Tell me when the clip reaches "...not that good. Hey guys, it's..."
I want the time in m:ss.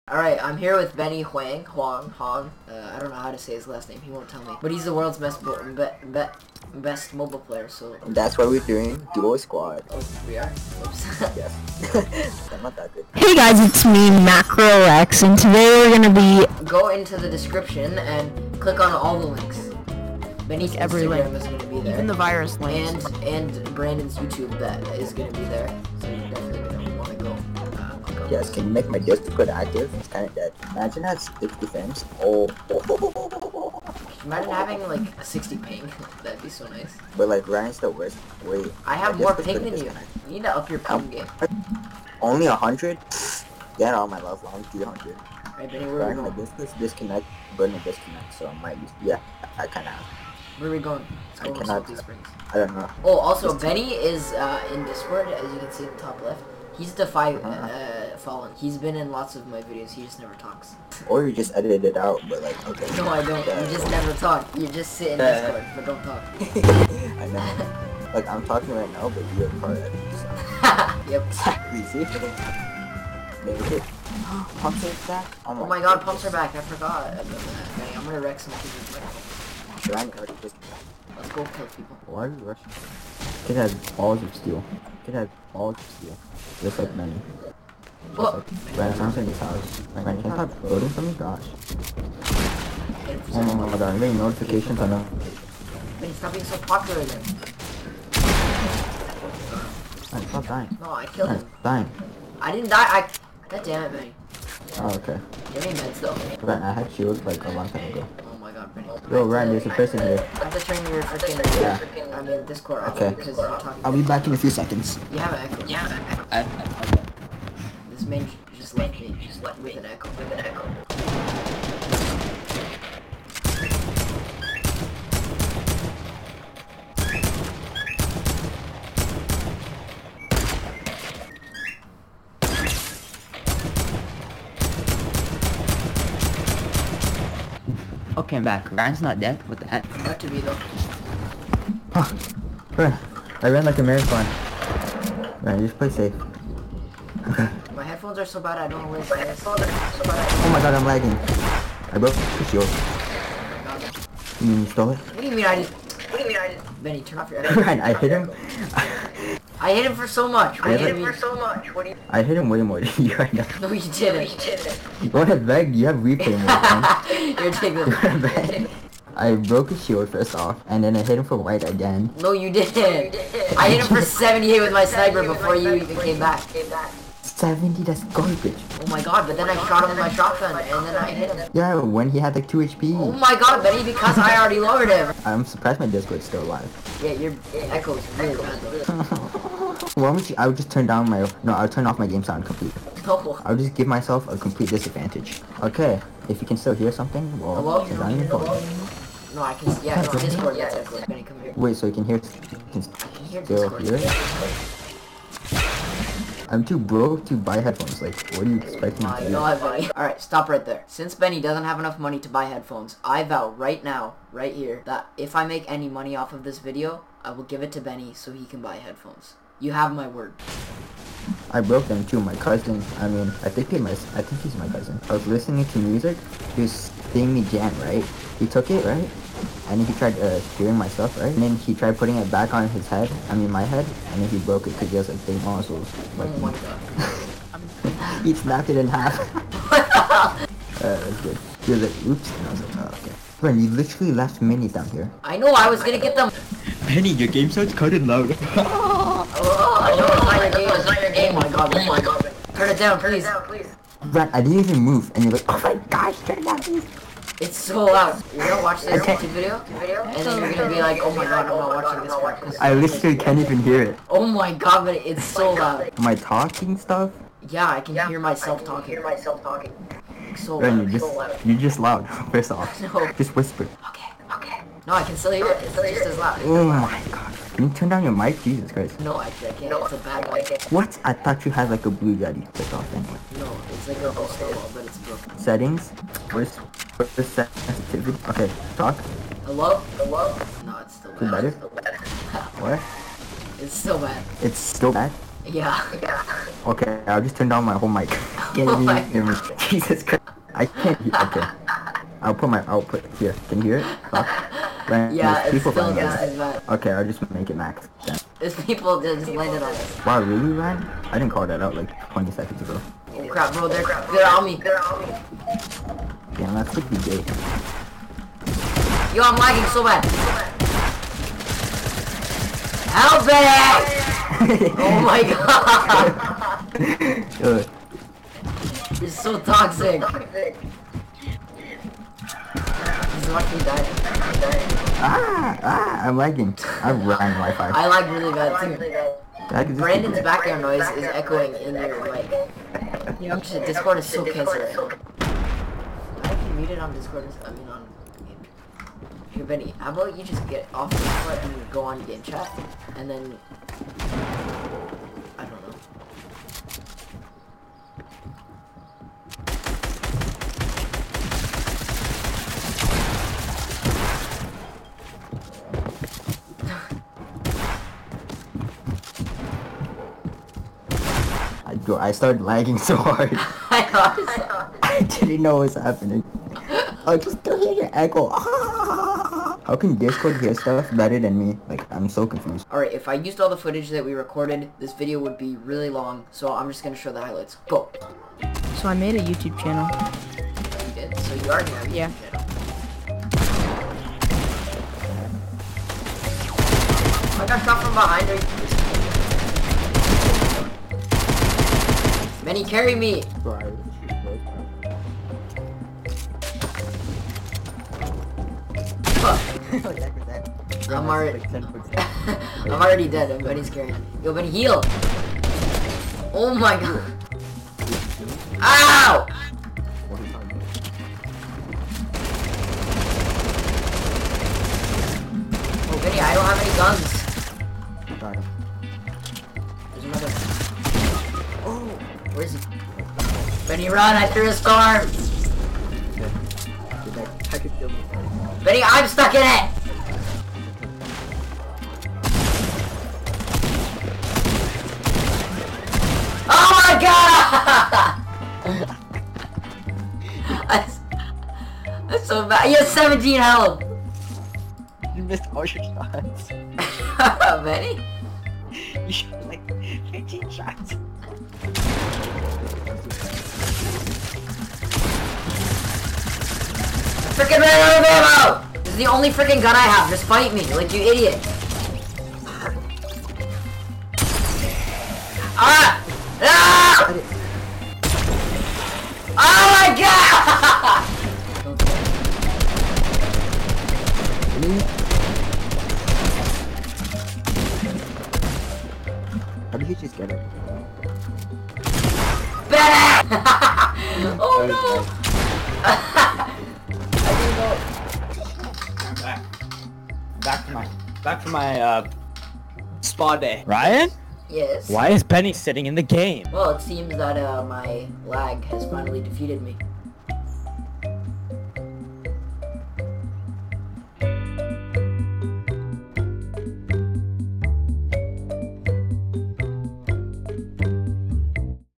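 0:12.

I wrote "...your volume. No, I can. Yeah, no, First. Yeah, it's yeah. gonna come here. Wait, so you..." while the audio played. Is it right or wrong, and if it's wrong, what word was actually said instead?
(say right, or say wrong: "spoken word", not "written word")
wrong: "Discord", not "First".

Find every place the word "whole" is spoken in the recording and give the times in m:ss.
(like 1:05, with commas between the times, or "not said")
4:57.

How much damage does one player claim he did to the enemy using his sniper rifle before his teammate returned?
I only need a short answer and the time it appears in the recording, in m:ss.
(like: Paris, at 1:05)
78, at 2:54.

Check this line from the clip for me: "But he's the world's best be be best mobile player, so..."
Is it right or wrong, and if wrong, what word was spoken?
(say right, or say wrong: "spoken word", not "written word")
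right.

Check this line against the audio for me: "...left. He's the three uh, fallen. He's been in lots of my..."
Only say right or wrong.
wrong.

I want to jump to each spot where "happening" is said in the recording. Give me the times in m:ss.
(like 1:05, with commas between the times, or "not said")
6:15.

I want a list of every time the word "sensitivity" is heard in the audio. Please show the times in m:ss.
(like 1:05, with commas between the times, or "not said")
4:47.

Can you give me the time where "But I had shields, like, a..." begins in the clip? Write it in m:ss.
1:46.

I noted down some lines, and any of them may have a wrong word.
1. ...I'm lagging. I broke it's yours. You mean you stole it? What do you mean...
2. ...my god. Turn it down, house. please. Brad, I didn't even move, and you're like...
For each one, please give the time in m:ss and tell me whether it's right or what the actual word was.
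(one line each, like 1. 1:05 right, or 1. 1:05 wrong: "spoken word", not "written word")
1. 2:30 right
2. 4:11 wrong: "please", not "house".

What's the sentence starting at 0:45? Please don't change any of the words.
Right, Benny, where are we going?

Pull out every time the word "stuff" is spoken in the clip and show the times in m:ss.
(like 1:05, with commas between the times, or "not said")
3:50, 4:26, 6:20.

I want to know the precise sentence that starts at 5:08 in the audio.
There's people that just landed on us.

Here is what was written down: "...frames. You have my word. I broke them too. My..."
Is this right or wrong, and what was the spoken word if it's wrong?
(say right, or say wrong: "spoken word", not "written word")
wrong: "headphones", not "frames".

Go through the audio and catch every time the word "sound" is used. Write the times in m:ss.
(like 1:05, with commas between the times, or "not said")
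3:12, 4:07.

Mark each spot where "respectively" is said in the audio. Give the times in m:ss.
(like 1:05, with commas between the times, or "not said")
not said.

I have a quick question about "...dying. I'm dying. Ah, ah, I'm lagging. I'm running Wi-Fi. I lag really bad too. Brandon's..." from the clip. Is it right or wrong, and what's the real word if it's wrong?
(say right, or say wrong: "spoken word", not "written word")
right.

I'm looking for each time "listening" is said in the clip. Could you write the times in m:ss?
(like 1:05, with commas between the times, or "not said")
3:45.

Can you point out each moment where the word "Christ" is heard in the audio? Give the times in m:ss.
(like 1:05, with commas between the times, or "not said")
4:38, 5:00.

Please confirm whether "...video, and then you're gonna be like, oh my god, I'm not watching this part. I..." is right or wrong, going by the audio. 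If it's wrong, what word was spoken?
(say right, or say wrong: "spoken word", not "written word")
right.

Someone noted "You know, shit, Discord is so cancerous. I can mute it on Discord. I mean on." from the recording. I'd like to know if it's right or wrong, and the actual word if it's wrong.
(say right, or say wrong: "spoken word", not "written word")
right.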